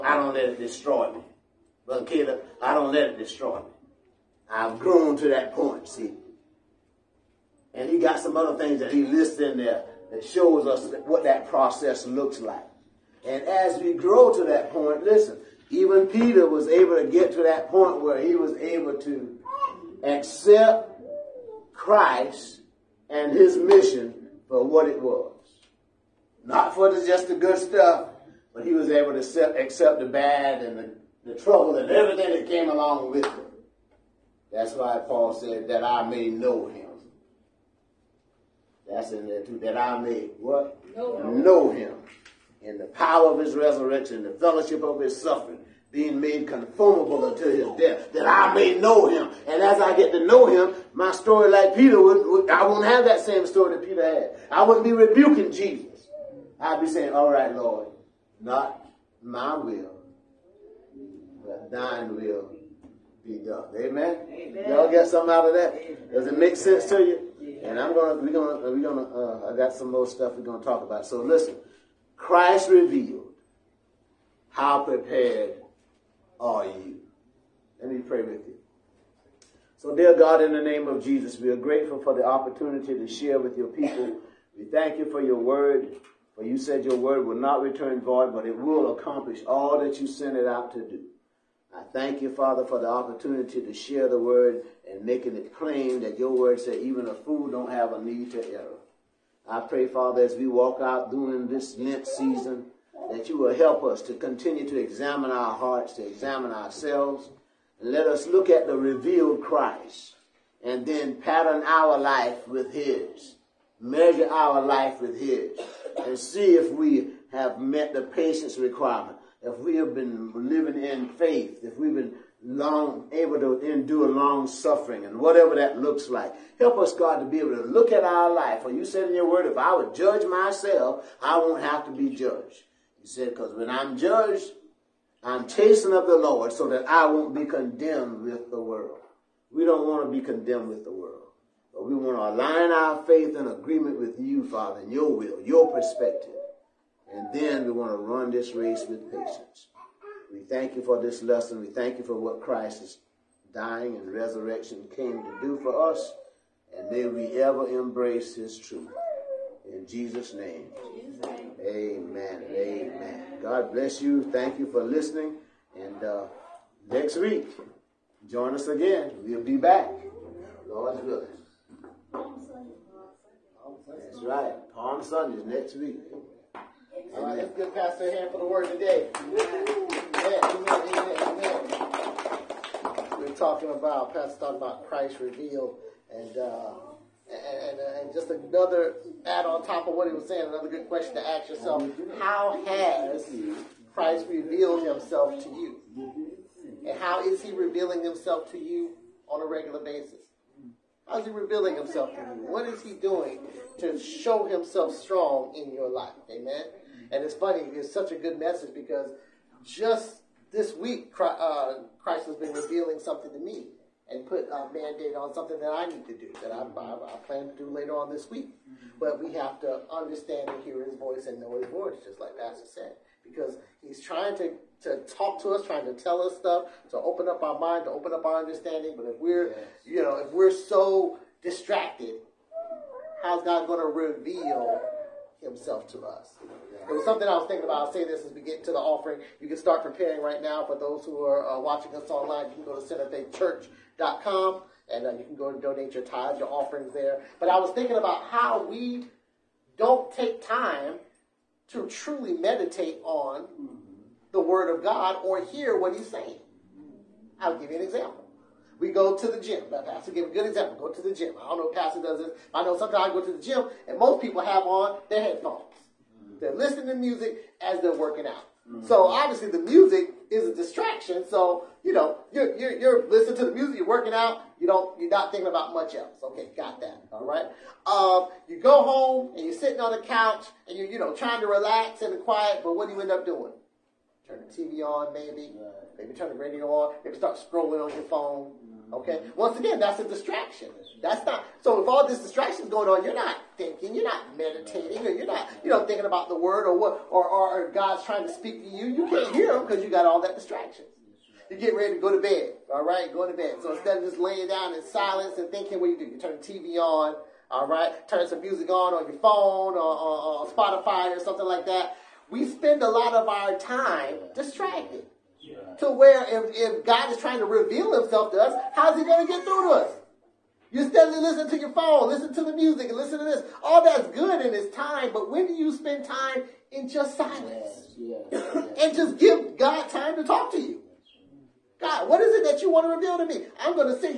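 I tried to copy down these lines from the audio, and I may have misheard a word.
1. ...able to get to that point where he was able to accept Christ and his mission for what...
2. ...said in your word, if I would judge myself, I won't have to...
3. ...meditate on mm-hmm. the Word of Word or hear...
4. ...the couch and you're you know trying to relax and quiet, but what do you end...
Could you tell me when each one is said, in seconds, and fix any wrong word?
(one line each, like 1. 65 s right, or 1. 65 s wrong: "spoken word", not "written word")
1. 16 s right
2. 128 s right
3. 252 s wrong: "God", not "Word"
4. 279 s right.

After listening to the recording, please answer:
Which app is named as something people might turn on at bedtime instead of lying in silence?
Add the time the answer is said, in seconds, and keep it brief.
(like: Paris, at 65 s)
Spotify, at 310 s.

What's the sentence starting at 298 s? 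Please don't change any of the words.
You can't hear him because you got all that distraction.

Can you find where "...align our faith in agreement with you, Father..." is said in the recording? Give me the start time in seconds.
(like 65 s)
142 s.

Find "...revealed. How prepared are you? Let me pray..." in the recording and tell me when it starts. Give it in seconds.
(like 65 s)
72 s.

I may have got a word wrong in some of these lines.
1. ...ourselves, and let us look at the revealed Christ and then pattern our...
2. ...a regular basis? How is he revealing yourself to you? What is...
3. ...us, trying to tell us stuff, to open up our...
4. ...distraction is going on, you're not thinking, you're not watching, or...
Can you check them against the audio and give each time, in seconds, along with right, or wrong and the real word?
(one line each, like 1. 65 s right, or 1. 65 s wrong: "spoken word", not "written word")
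1. 106 s right
2. 199 s wrong: "himself", not "yourself"
3. 225 s right
4. 292 s wrong: "meditating", not "watching".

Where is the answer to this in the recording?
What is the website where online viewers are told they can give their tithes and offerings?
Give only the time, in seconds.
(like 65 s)
242 s.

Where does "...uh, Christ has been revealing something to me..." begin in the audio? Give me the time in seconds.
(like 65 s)
211 s.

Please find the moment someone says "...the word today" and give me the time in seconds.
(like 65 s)
178 s.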